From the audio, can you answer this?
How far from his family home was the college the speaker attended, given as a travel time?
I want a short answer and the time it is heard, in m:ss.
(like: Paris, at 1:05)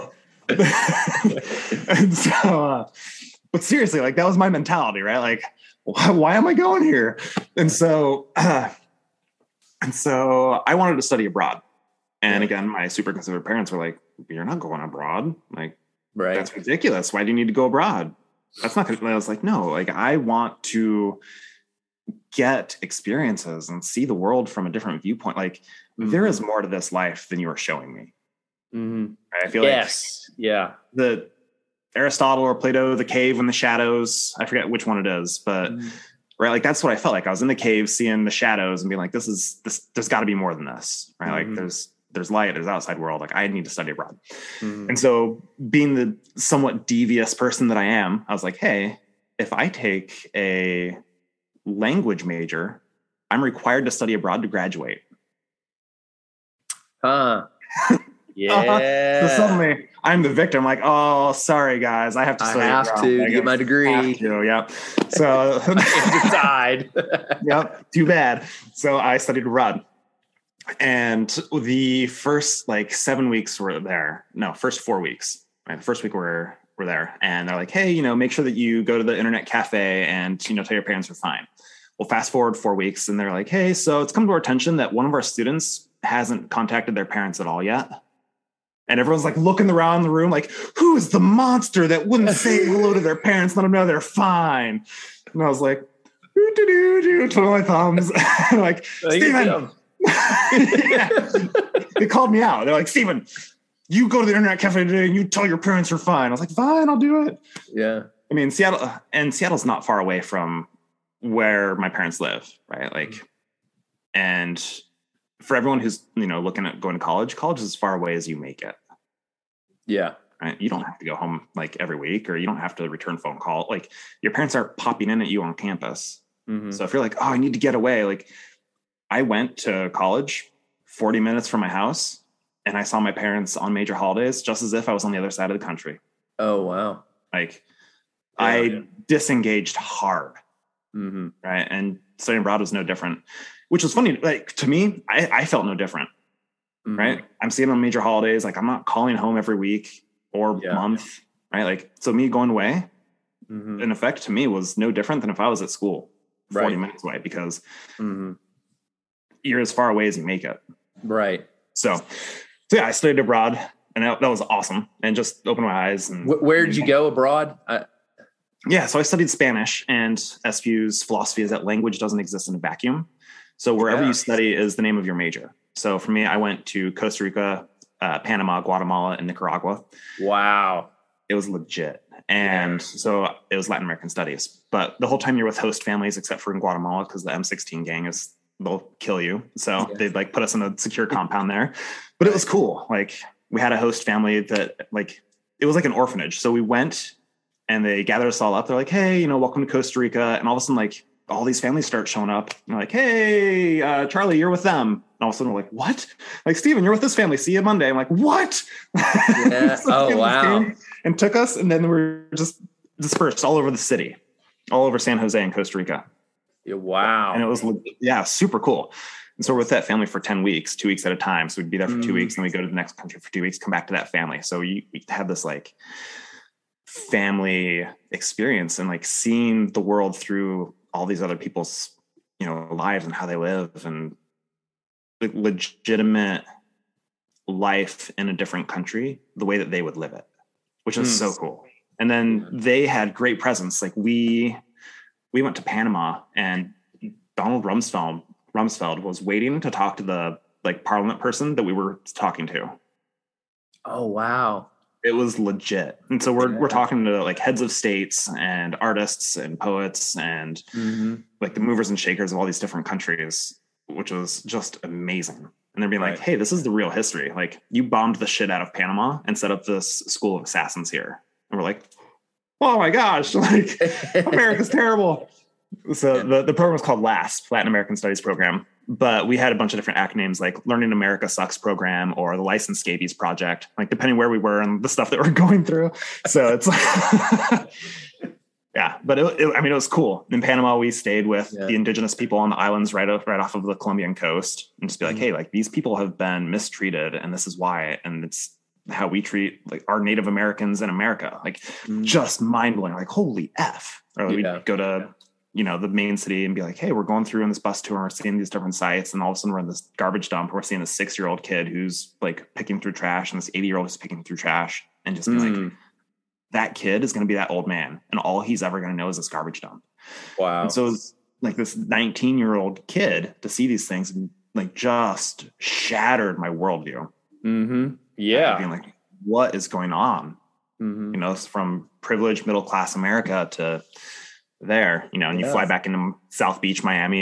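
40 minutes, at 2:10.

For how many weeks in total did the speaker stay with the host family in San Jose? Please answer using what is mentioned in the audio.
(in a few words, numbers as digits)
10 weeks.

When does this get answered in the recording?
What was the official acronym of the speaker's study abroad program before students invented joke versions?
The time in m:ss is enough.
4:37.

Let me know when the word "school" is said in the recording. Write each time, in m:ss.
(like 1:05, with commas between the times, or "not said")
2:35, 4:30.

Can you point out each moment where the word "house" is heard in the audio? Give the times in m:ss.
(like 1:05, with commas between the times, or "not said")
2:11.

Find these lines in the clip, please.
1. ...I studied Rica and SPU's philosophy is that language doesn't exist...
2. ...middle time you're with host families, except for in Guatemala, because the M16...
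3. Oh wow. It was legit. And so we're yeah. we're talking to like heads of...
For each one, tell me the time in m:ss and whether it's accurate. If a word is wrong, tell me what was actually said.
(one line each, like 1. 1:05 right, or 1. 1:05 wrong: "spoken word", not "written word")
1. 2:49 wrong: "Spanish", not "Rica"
2. 3:05 wrong: "whole", not "middle"
3. 4:13 right.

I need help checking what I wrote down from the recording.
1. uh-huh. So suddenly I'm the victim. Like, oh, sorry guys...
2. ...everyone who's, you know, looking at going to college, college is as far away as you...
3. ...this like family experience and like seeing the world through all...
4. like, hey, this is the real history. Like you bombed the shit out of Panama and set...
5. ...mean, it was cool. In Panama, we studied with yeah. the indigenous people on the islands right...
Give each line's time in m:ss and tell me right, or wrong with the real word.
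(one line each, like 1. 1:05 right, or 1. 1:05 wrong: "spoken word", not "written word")
1. 0:58 right
2. 1:55 right
3. 3:45 right
4. 4:26 right
5. 4:49 wrong: "stayed", not "studied".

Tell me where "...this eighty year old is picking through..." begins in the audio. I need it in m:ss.
5:13.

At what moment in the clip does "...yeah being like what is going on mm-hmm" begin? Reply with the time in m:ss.
5:28.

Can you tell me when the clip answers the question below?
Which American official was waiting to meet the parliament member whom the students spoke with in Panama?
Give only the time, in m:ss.
4:07.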